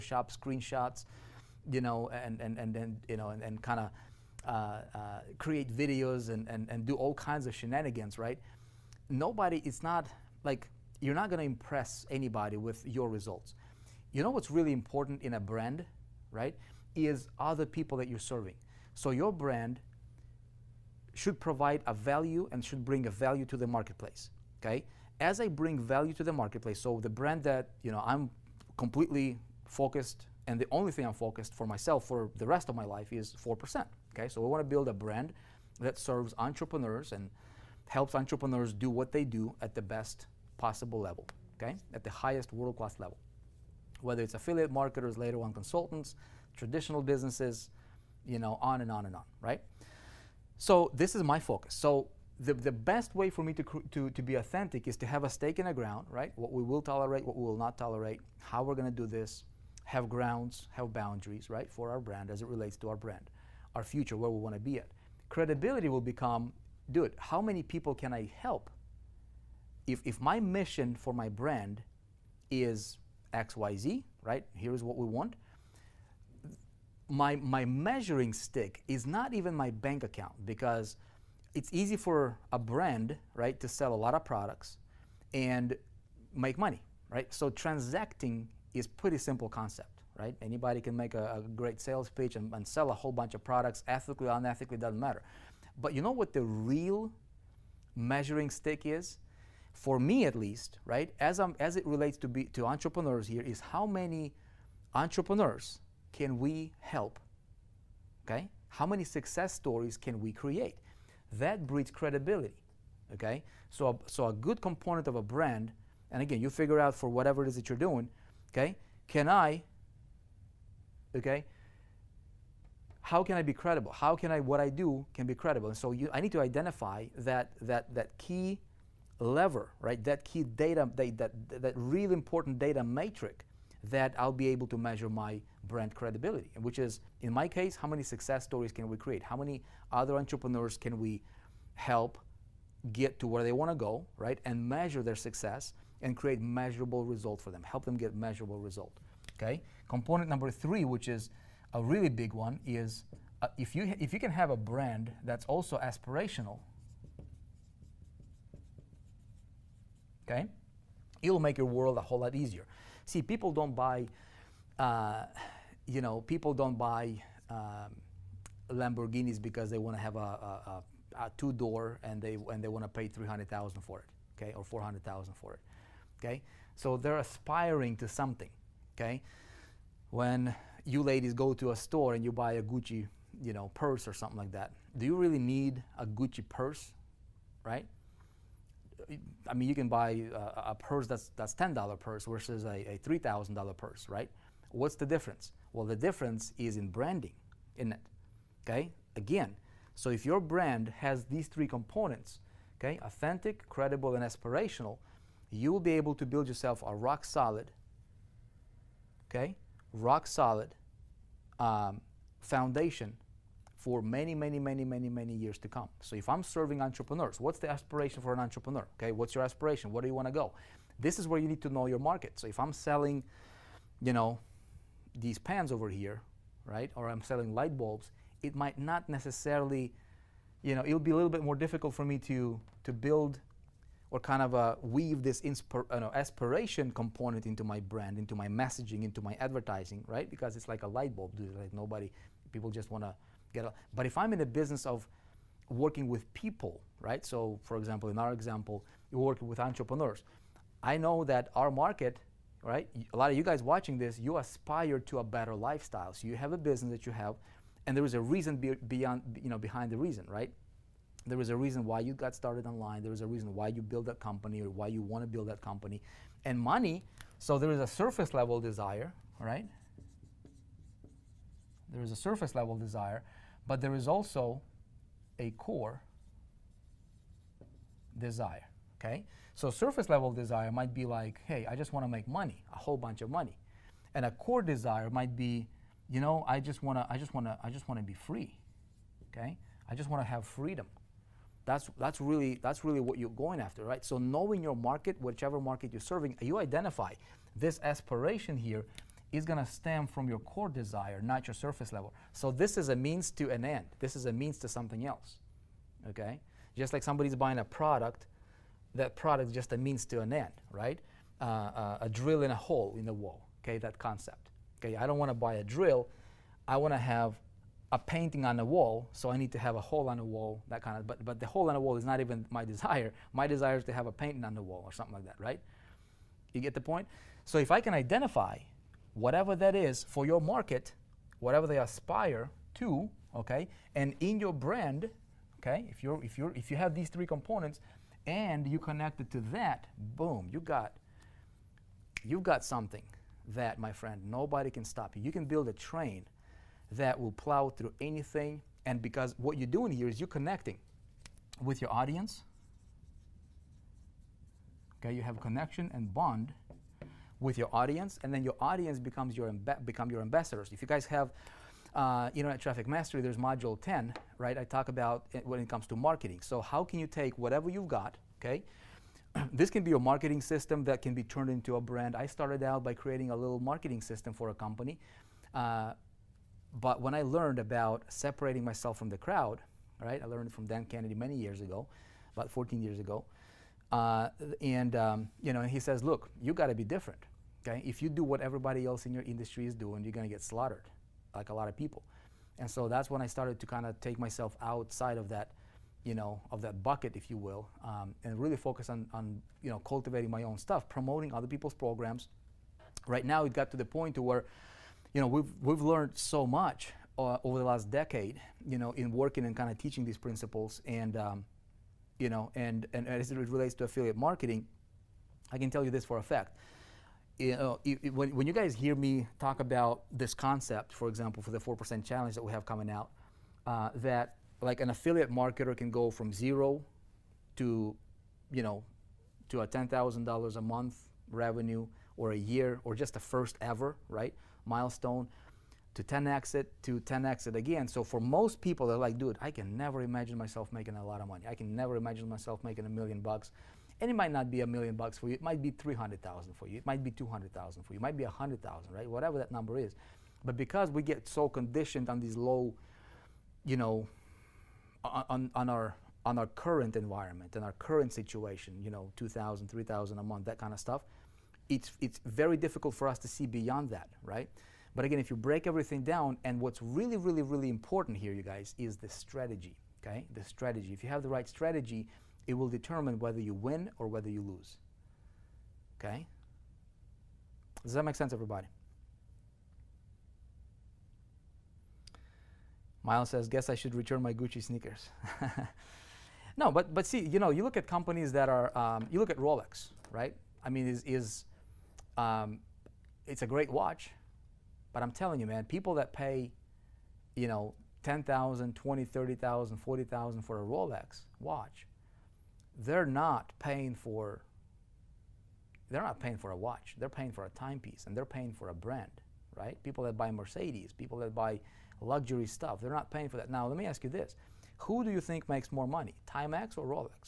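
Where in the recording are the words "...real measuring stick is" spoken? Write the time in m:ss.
1:36.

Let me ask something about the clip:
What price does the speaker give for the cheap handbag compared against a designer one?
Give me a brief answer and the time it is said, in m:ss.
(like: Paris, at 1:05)
$10, at 3:11.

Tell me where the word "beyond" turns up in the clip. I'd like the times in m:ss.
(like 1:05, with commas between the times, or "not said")
4:18, 7:43.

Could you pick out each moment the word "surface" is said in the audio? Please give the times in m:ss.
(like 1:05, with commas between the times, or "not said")
4:27, 4:32, 4:39, 5:01.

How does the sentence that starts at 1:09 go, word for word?
If, if my mission for my brand is XYZ, right?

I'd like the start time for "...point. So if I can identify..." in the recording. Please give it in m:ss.
5:26.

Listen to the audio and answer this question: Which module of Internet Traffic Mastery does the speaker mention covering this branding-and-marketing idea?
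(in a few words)
Module 10.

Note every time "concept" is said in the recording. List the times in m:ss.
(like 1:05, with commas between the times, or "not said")
1:29, 5:13, 7:00.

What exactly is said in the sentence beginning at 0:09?
Nobody, it's not, like, you're not gonna impress anybody with your results.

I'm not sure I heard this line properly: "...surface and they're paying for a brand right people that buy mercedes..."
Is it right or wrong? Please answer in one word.
wrong.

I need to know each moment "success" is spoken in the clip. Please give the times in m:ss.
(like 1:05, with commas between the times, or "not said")
1:49, 2:18, 2:25.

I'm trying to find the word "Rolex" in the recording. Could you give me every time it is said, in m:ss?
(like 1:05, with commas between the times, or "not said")
8:09, 8:20.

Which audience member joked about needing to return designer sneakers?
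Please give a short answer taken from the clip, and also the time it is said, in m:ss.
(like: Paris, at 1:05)
Miles, at 8:03.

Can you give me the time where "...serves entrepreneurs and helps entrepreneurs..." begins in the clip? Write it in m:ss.
0:35.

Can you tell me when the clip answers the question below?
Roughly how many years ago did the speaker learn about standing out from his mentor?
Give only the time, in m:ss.
6:22.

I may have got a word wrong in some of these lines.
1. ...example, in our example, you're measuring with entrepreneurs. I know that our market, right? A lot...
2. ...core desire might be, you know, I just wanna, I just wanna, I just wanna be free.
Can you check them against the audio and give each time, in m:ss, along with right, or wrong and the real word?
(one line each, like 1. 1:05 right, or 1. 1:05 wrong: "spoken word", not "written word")
1. 4:07 wrong: "working", not "measuring"
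2. 4:44 right.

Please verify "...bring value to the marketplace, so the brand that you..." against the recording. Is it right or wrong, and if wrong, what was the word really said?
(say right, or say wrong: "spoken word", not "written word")
right.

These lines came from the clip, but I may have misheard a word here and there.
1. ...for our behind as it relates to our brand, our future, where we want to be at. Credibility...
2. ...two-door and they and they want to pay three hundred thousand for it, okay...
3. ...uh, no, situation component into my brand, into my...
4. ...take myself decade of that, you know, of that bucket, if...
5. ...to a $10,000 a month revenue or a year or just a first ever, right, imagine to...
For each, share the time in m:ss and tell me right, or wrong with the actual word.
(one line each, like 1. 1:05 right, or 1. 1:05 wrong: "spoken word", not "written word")
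1. 1:01 wrong: "brand", not "behind"
2. 2:51 right
3. 3:55 wrong: "aspiration", not "situation"
4. 6:33 wrong: "outside", not "decade"
5. 7:09 wrong: "milestone", not "imagine".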